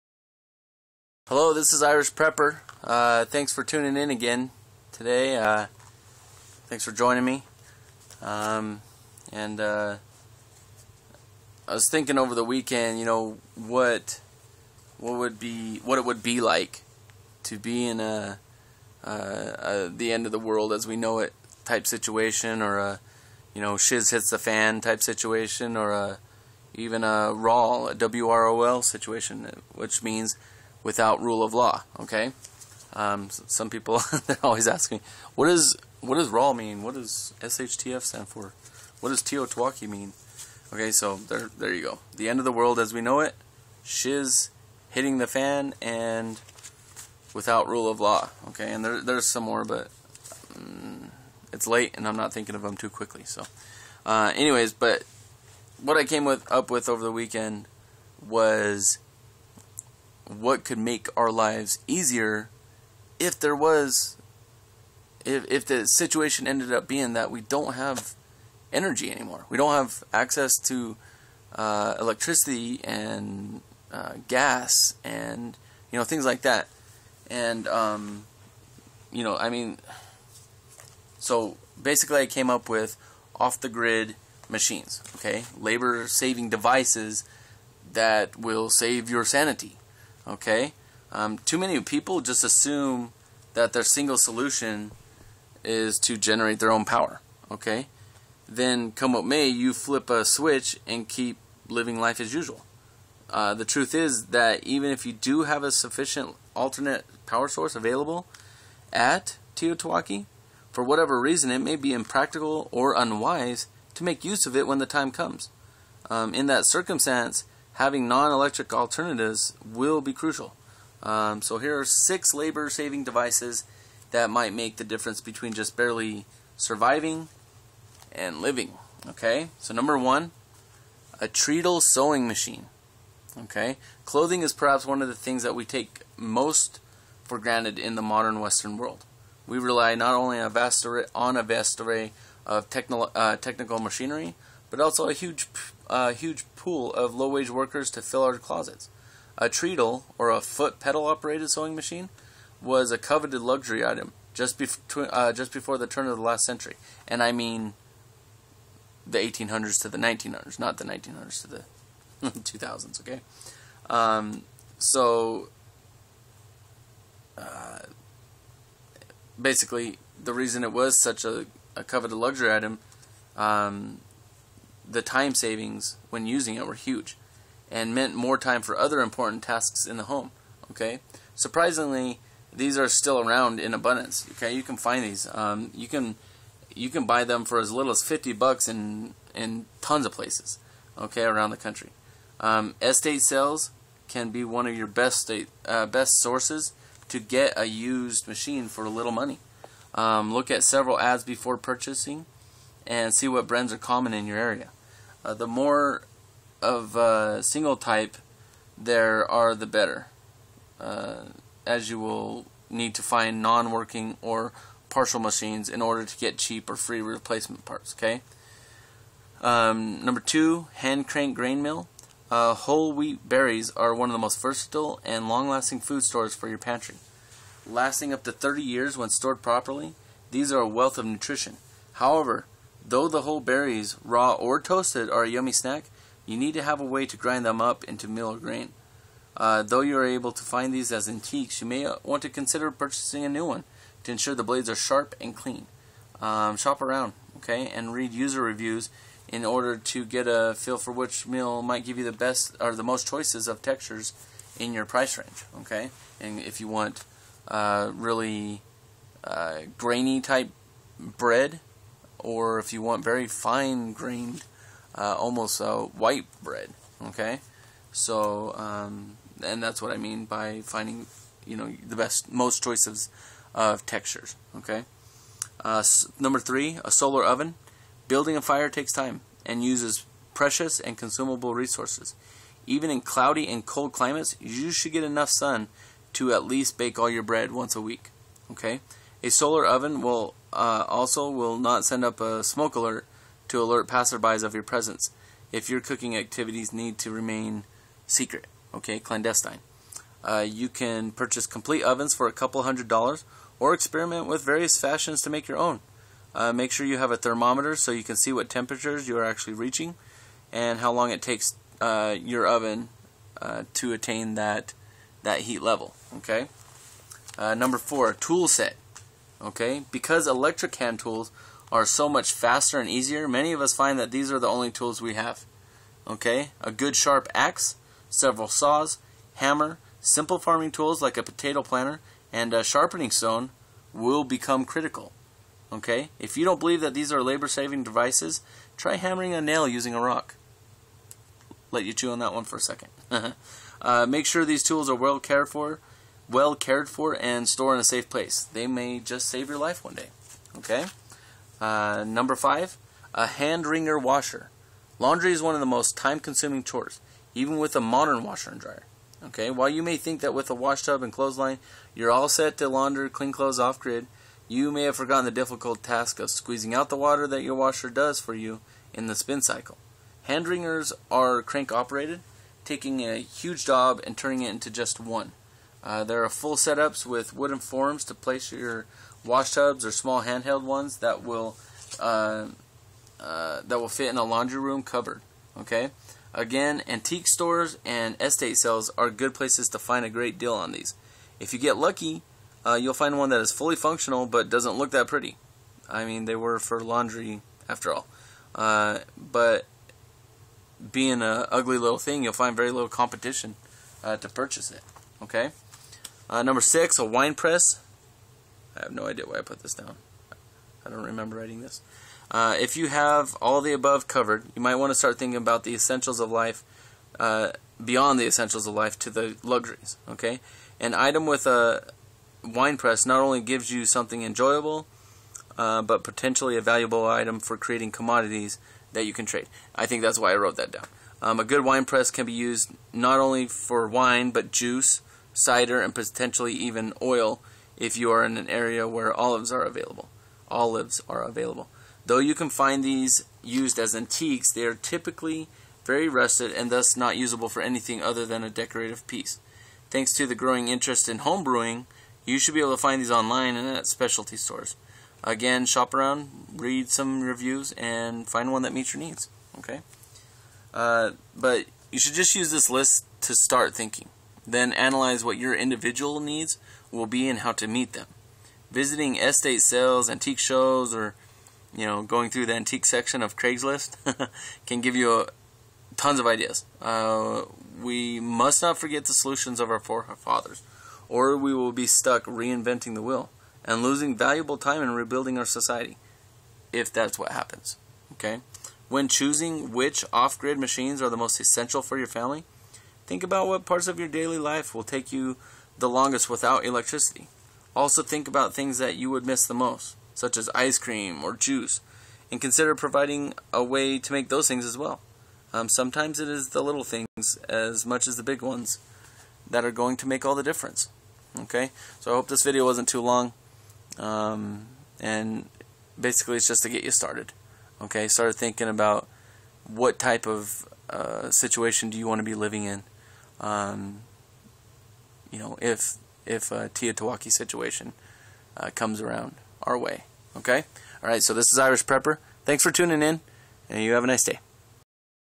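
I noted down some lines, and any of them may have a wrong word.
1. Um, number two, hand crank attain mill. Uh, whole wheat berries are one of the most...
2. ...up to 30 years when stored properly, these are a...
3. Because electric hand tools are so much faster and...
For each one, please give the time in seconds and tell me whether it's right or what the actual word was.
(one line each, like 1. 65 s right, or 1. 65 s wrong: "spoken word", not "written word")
1. 219 s wrong: "grain", not "attain"
2. 228 s right
3. 319 s right.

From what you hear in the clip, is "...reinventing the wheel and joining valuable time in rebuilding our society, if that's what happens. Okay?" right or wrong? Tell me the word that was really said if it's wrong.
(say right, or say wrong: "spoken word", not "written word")
wrong: "losing", not "joining".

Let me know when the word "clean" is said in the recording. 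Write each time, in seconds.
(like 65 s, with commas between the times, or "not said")
245 s, 363 s.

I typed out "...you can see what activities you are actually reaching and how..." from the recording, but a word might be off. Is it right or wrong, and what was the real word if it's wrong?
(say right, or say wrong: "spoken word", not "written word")
wrong: "temperatures", not "activities".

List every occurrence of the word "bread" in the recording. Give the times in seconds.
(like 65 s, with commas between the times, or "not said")
260 s, 266 s, 287 s.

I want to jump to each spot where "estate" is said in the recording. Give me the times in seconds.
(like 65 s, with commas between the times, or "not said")
192 s, 388 s, 469 s.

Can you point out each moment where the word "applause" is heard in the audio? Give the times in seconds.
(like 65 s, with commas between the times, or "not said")
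not said.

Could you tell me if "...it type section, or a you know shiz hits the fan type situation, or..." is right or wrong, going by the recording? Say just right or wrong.
wrong.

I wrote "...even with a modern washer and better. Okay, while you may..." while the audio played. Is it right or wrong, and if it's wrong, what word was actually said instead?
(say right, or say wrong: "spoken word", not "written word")
wrong: "dryer", not "better".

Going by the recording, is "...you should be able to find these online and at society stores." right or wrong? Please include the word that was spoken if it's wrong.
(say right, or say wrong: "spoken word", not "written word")
wrong: "specialty", not "society".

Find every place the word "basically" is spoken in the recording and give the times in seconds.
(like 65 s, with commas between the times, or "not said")
81 s, 169 s, 515 s.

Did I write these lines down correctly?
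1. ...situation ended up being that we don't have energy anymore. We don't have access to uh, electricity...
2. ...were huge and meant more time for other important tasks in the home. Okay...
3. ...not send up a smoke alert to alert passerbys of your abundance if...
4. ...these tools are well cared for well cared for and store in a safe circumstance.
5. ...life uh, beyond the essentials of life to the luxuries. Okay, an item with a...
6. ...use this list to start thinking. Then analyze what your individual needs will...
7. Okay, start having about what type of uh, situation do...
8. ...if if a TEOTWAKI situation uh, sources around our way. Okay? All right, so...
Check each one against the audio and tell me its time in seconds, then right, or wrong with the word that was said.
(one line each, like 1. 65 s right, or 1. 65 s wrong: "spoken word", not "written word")
1. 65 s right
2. 176 s right
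3. 291 s wrong: "presence", not "abundance"
4. 344 s wrong: "place", not "circumstance"
5. 416 s right
6. 462 s right
7. 517 s wrong: "thinking", not "having"
8. 525 s wrong: "comes", not "sources".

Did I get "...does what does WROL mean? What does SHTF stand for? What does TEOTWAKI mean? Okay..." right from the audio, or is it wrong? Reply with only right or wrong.
right.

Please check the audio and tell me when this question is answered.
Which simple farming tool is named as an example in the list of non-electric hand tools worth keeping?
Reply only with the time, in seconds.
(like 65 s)
331 s.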